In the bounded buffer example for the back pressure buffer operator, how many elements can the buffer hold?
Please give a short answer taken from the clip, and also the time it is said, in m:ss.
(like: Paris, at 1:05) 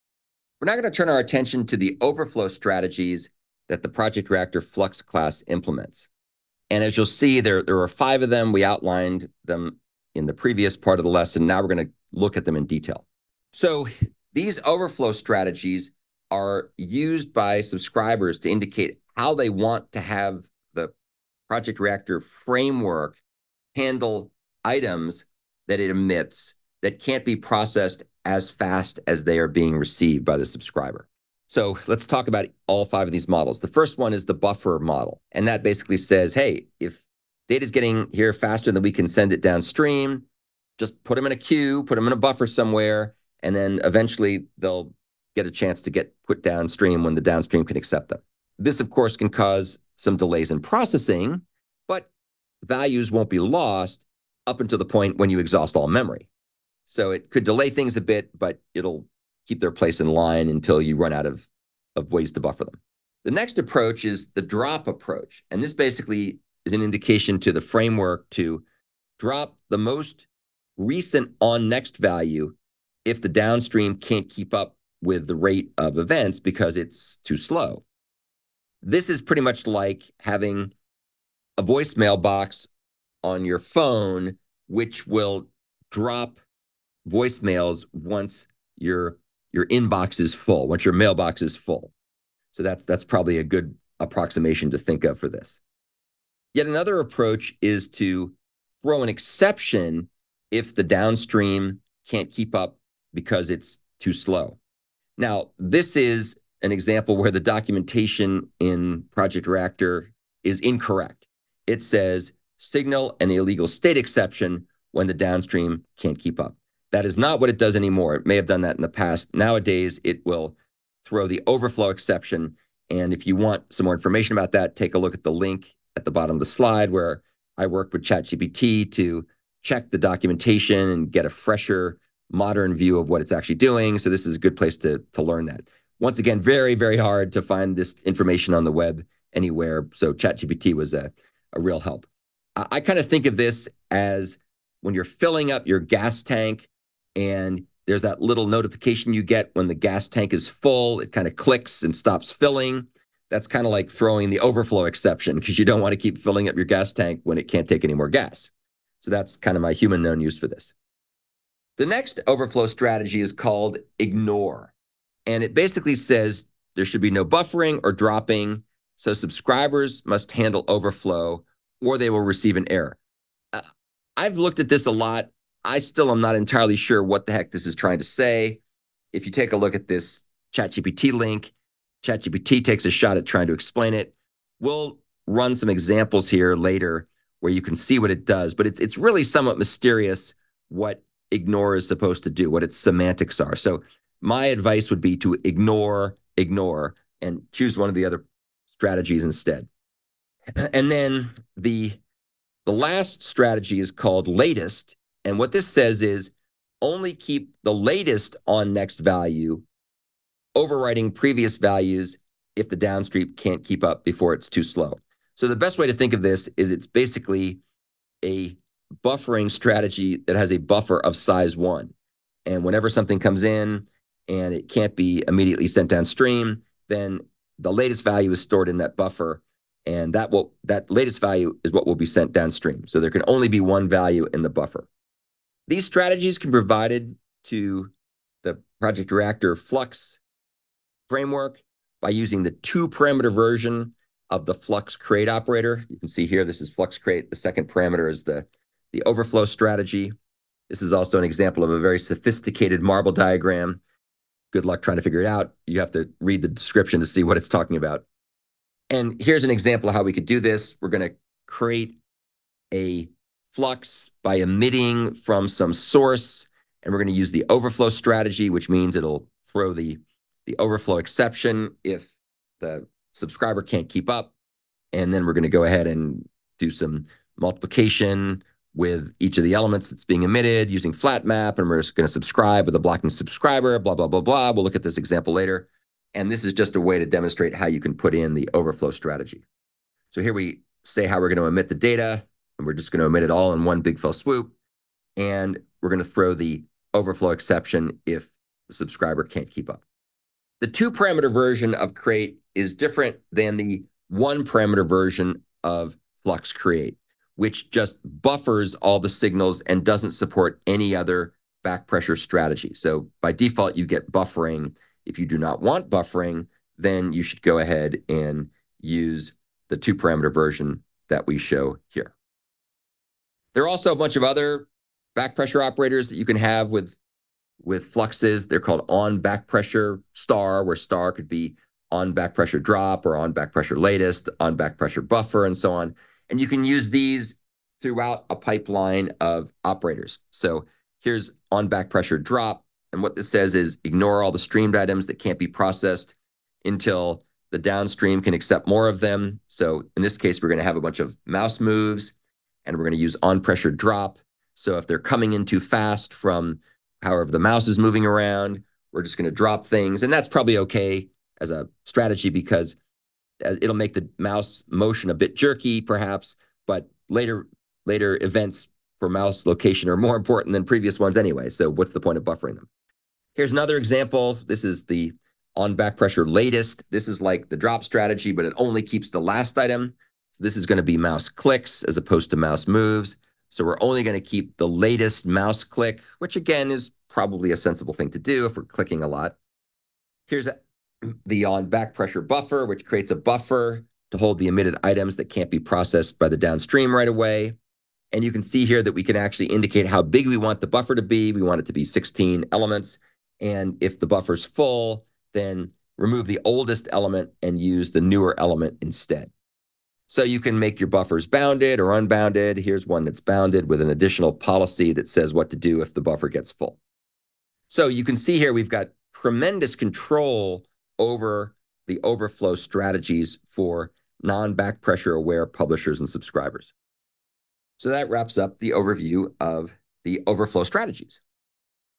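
16, at 6:41.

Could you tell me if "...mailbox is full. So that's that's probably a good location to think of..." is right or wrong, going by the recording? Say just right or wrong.
wrong.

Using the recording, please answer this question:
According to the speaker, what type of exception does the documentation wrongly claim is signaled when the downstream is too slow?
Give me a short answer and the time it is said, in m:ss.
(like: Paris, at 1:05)
Illegal state exception, at 1:53.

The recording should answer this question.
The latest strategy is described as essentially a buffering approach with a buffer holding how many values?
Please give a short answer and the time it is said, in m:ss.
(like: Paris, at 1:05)
1, at 3:41.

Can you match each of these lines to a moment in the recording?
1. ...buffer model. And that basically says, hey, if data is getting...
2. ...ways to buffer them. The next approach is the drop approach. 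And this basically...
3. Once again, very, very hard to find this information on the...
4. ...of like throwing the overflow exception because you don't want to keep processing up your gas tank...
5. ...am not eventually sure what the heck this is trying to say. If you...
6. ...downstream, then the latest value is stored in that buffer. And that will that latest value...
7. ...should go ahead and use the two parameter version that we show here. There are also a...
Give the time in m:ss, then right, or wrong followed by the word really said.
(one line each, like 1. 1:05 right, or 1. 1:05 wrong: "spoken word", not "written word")
1. 0:34 right
2. 1:02 right
3. 2:15 right
4. 2:33 wrong: "filling", not "processing"
5. 2:56 wrong: "entirely", not "eventually"
6. 3:45 right
7. 5:17 right.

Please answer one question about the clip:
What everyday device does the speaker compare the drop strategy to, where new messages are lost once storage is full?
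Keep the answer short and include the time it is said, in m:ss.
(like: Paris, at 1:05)
Voicemail box, at 1:21.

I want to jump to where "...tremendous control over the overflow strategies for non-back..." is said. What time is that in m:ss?
6:59.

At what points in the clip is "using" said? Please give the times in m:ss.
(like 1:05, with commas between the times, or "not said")
4:02, 4:40.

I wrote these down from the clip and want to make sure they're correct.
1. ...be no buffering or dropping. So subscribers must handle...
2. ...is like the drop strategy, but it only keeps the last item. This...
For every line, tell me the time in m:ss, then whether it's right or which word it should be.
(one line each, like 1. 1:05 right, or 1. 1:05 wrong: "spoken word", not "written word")
1. 2:47 right
2. 6:17 right.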